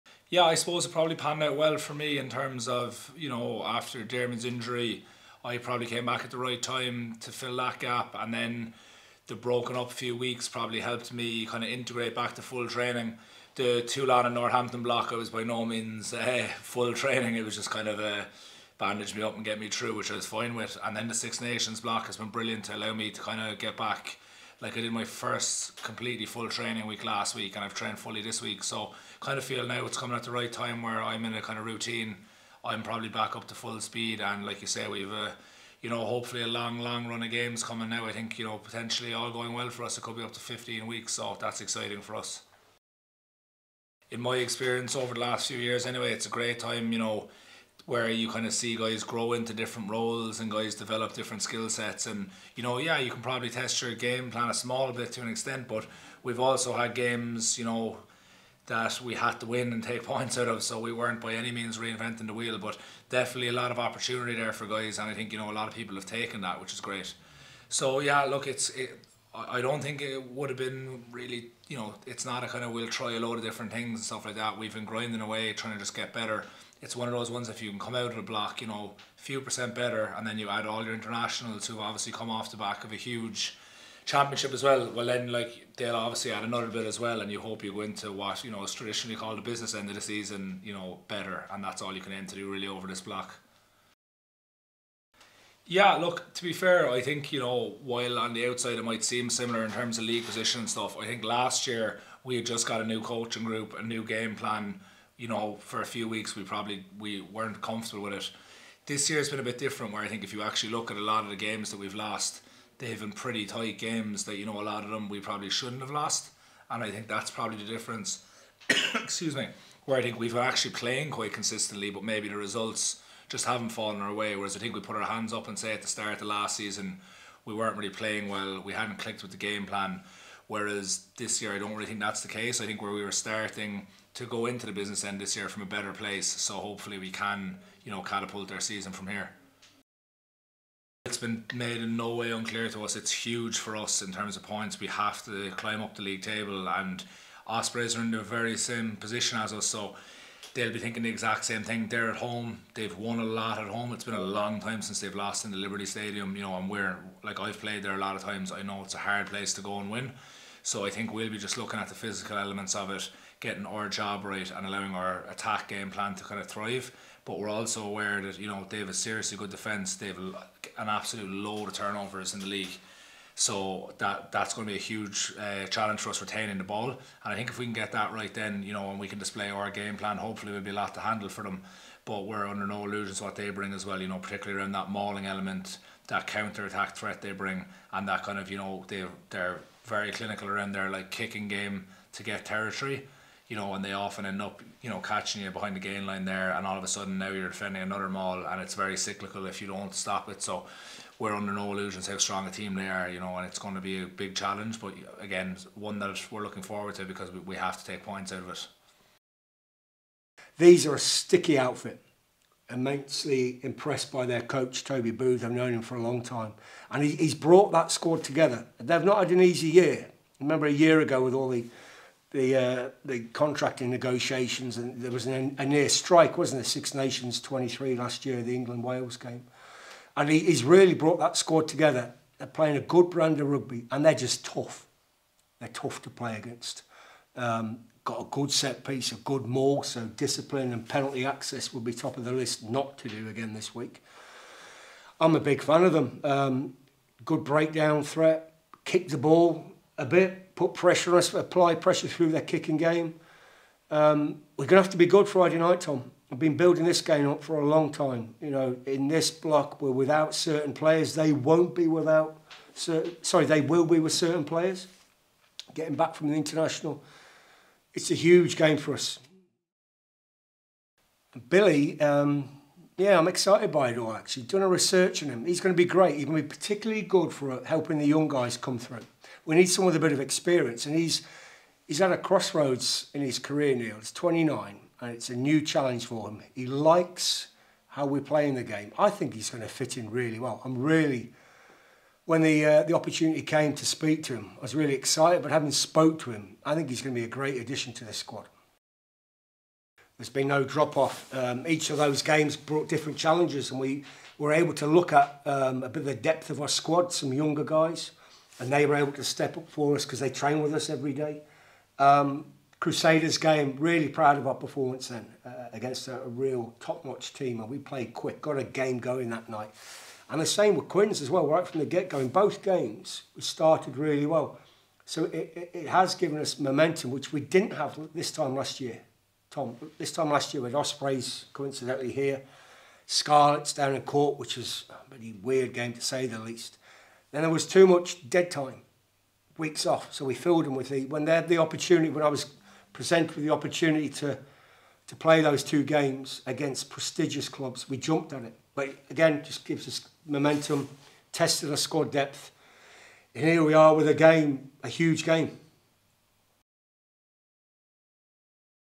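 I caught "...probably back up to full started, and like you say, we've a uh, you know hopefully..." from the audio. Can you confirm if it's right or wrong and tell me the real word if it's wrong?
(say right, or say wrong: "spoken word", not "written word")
wrong: "speed", not "started".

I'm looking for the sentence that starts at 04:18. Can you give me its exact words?
You know, in this block, we're without certain players.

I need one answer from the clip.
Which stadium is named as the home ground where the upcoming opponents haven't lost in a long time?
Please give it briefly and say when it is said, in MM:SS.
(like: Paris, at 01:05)
Liberty Stadium, at 02:35.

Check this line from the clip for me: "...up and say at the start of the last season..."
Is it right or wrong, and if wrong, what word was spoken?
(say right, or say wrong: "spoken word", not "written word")
right.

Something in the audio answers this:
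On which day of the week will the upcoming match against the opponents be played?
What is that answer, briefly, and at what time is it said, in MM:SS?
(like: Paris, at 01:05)
Friday, at 04:15.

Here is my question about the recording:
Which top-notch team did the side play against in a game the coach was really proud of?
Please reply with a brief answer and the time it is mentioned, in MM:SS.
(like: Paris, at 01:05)
Crusaders, at 05:12.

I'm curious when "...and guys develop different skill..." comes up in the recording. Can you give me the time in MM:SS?
00:50.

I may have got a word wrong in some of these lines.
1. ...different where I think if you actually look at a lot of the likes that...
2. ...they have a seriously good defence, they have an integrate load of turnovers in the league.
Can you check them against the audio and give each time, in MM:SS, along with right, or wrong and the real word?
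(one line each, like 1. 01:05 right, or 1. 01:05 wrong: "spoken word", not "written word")
1. 01:49 wrong: "games", not "likes"
2. 02:48 wrong: "absolute", not "integrate".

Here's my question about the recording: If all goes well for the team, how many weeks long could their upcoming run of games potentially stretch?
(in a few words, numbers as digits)
15 weeks.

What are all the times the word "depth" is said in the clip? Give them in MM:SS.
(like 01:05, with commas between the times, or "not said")
05:06, 05:52.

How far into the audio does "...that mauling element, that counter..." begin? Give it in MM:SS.
03:04.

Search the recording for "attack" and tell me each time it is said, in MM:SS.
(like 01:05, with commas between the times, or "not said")
02:45, 03:06.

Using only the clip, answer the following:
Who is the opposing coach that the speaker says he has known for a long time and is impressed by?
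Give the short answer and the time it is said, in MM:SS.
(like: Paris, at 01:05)
Toby Booth, at 03:34.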